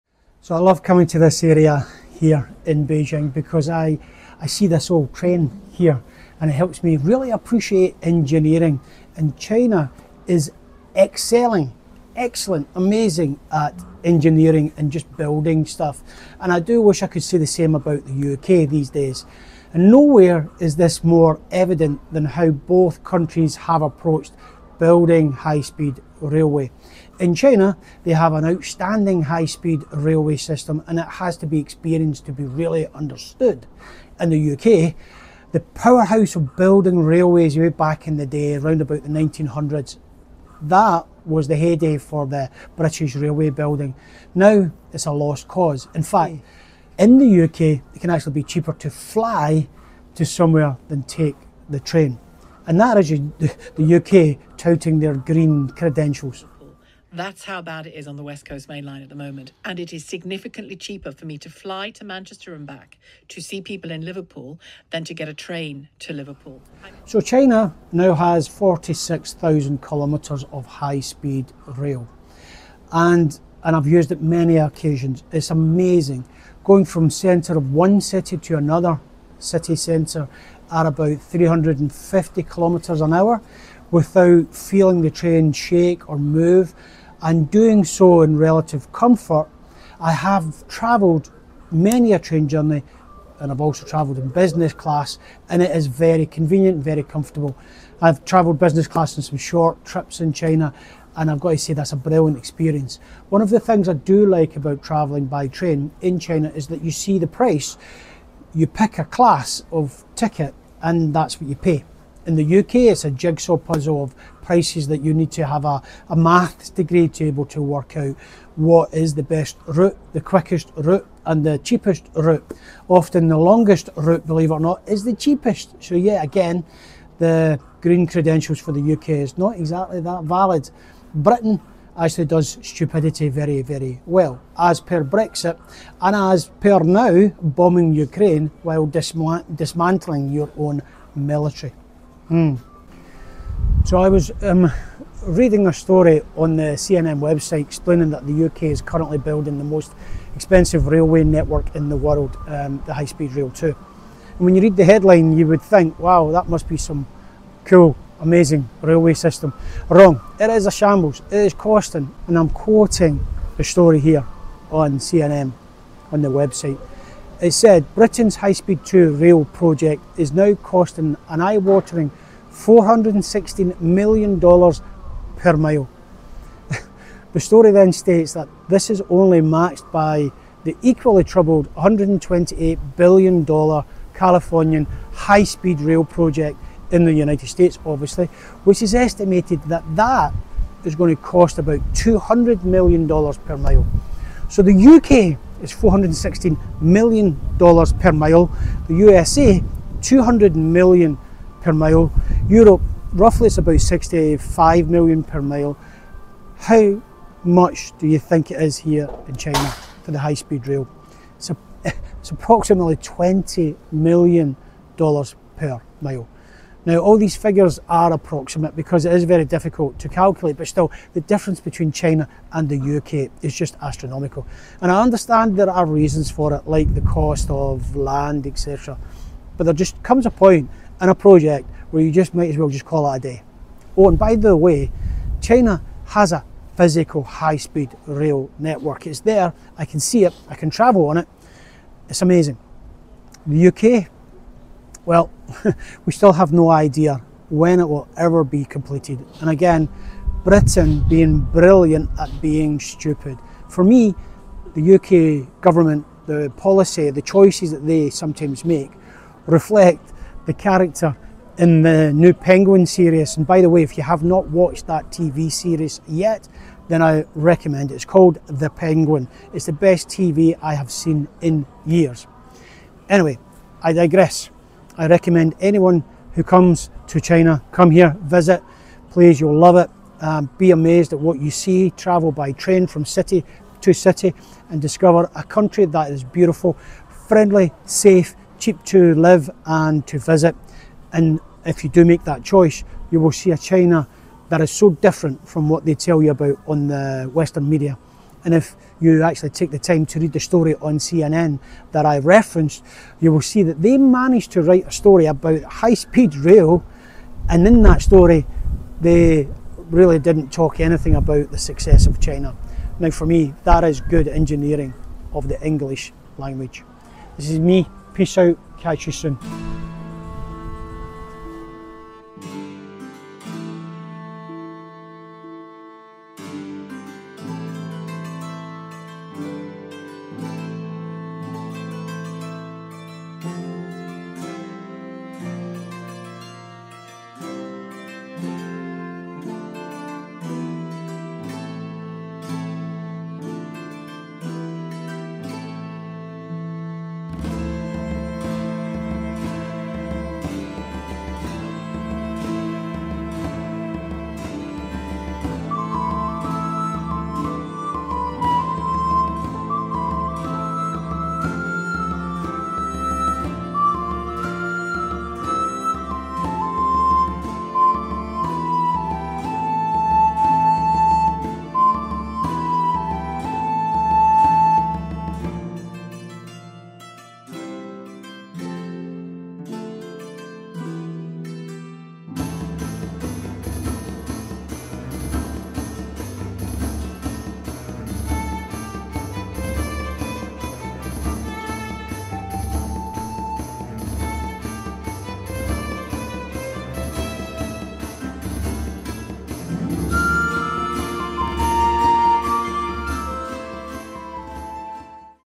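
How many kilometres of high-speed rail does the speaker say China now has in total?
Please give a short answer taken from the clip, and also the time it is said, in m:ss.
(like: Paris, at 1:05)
46,000 kilometres, at 1:08.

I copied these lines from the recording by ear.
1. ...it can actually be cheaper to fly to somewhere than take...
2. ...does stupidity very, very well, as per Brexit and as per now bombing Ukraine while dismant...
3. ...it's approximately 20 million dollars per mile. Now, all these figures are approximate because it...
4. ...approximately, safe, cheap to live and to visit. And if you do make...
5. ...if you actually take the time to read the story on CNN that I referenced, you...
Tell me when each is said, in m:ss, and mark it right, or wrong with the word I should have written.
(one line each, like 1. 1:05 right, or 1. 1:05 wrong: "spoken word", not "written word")
1. 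0:47 right
2. 2:12 right
3. 3:32 right
4. 4:47 wrong: "friendly", not "approximately"
5. 4:58 right.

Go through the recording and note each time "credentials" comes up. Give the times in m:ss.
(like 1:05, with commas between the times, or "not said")
0:55, 2:08.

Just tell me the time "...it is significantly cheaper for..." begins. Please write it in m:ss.
0:59.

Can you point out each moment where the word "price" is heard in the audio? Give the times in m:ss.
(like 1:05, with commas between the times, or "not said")
1:47, 1:54.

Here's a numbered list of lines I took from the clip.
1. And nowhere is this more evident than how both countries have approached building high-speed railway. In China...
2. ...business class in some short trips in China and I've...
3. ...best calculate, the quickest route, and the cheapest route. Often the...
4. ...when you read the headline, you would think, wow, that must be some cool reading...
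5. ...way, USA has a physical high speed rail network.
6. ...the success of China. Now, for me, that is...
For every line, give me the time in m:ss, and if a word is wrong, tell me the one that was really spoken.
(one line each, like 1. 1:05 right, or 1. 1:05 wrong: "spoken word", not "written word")
1. 0:19 right
2. 1:38 right
3. 1:59 wrong: "route", not "calculate"
4. 2:34 wrong: "amazing", not "reading"
5. 3:54 wrong: "China", not "USA"
6. 5:11 right.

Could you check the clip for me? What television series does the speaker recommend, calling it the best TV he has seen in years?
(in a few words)
The Penguin.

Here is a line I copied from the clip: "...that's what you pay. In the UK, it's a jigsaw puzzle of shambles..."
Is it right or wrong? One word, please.
wrong.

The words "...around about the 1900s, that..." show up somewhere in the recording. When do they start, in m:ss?
0:38.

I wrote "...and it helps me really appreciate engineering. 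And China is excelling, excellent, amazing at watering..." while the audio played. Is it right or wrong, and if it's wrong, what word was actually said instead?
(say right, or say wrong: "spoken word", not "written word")
wrong: "engineering", not "watering".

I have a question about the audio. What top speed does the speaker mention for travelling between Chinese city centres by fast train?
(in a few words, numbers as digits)
350 kilometres an hour.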